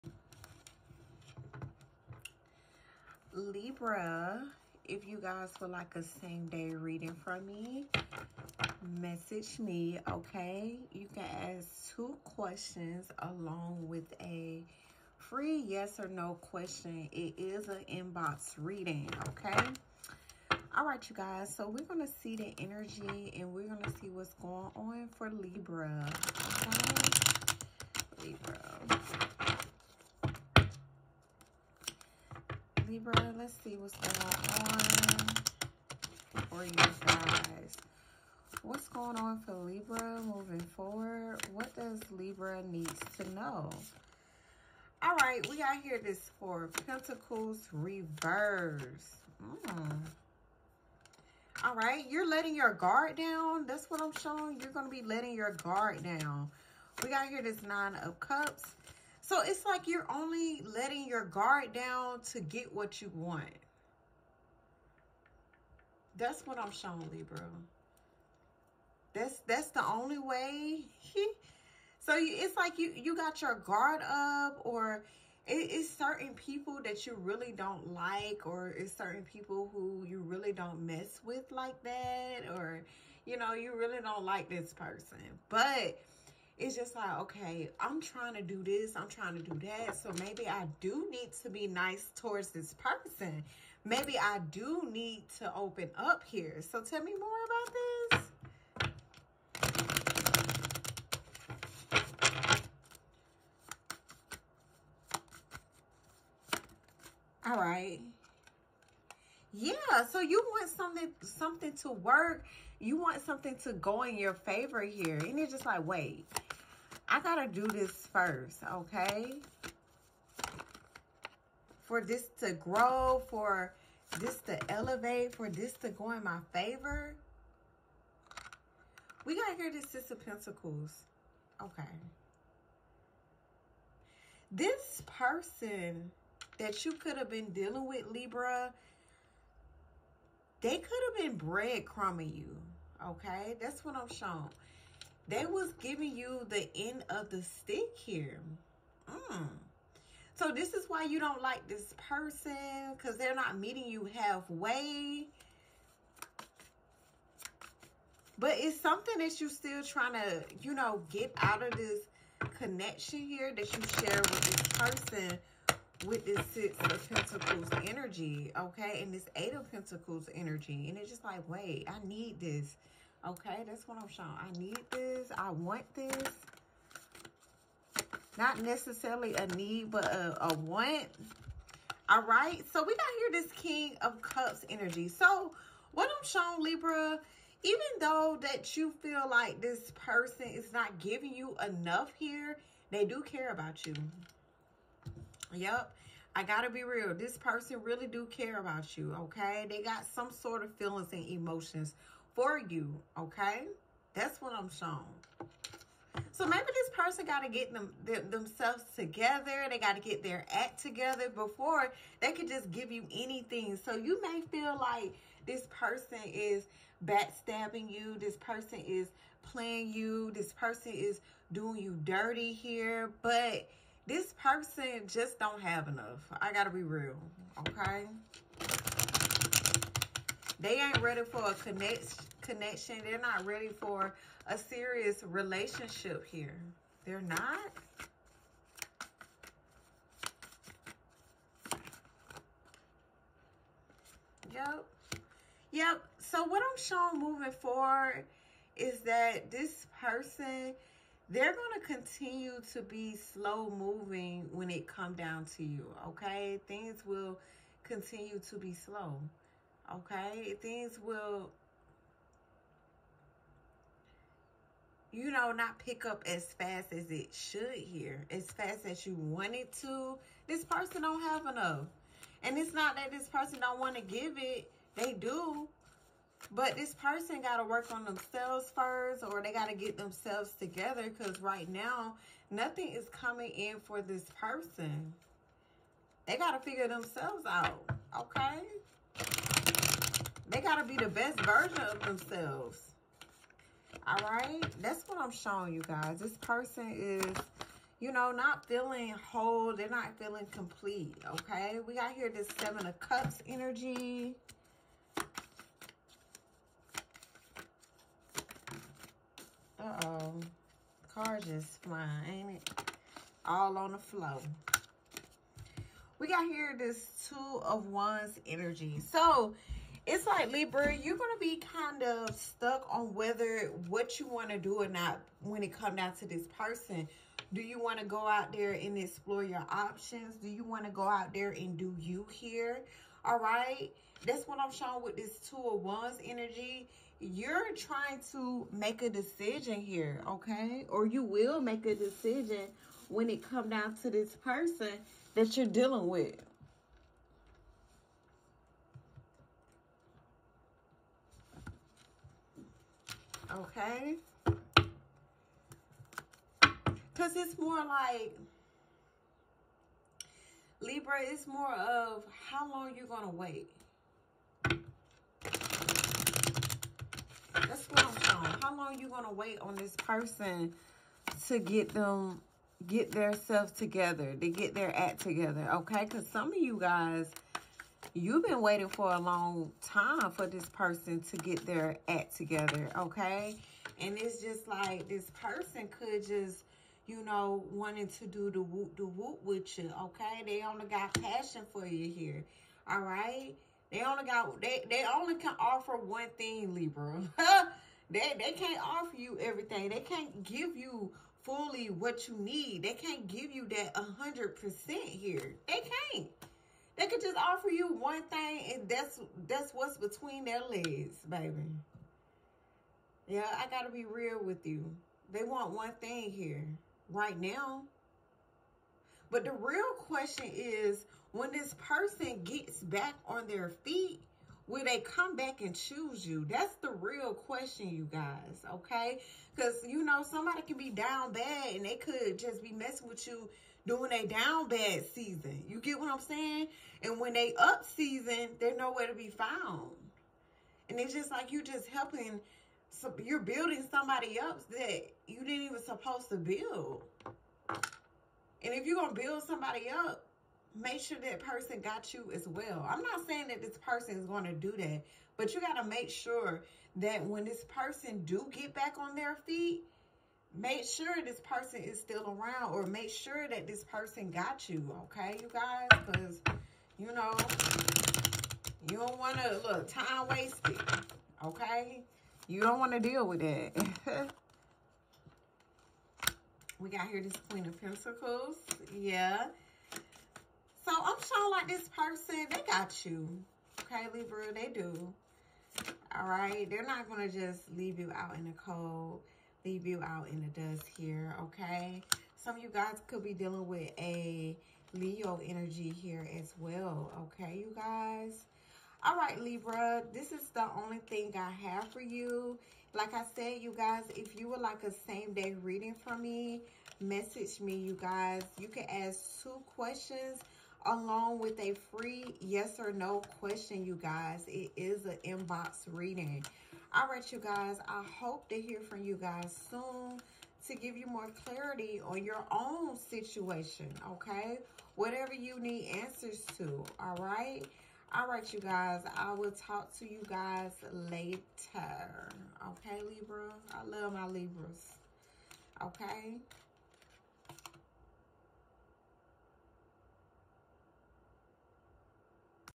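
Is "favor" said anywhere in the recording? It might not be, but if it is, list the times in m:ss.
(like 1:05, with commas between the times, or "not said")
1:54, 2:06.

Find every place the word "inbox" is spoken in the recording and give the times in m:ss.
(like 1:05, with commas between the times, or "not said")
0:17, 8:35.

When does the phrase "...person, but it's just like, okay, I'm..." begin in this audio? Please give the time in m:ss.
1:24.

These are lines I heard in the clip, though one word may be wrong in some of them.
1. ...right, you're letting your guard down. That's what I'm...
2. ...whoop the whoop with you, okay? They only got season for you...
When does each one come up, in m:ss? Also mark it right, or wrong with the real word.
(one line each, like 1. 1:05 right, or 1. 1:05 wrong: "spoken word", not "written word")
1. 0:51 right
2. 6:28 wrong: "passion", not "season".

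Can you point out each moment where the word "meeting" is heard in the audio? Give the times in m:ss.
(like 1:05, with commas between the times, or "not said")
2:33.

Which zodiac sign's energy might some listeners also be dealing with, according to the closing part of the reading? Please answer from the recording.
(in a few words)
Leo.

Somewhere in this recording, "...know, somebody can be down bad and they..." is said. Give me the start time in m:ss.
7:10.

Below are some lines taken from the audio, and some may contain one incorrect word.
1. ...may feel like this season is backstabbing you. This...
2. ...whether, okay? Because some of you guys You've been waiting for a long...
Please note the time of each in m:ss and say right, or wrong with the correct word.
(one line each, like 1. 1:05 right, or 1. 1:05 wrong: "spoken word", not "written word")
1. 3:34 wrong: "person", not "season"
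2. 6:15 wrong: "together", not "whether".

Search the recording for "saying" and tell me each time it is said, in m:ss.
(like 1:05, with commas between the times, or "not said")
7:16, 7:33.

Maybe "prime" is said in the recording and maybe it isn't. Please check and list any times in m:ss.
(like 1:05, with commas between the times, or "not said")
not said.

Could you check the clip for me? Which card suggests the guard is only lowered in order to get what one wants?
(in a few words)
Nine of Cups.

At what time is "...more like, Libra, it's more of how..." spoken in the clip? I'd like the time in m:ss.
5:57.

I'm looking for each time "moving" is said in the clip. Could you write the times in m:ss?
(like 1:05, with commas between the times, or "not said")
0:40, 4:07, 4:13.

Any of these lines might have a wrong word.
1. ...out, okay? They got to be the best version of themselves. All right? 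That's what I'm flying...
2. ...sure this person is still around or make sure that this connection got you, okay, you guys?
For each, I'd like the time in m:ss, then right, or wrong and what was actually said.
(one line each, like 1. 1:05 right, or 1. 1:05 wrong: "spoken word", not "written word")
1. 4:47 wrong: "showing", not "flying"
2. 7:40 wrong: "person", not "connection".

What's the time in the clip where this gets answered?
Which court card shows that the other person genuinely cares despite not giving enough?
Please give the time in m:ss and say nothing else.
3:03.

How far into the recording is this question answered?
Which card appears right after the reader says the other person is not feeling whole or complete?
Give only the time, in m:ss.
5:02.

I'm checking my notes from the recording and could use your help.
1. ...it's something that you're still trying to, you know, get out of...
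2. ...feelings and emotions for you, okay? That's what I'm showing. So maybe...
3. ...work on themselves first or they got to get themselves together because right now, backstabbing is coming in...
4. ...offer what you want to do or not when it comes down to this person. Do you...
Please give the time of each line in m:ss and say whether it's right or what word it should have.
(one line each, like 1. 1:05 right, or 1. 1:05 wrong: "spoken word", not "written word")
1. 2:38 right
2. 3:20 right
3. 4:37 wrong: "nothing", not "backstabbing"
4. 5:23 wrong: "whether", not "offer".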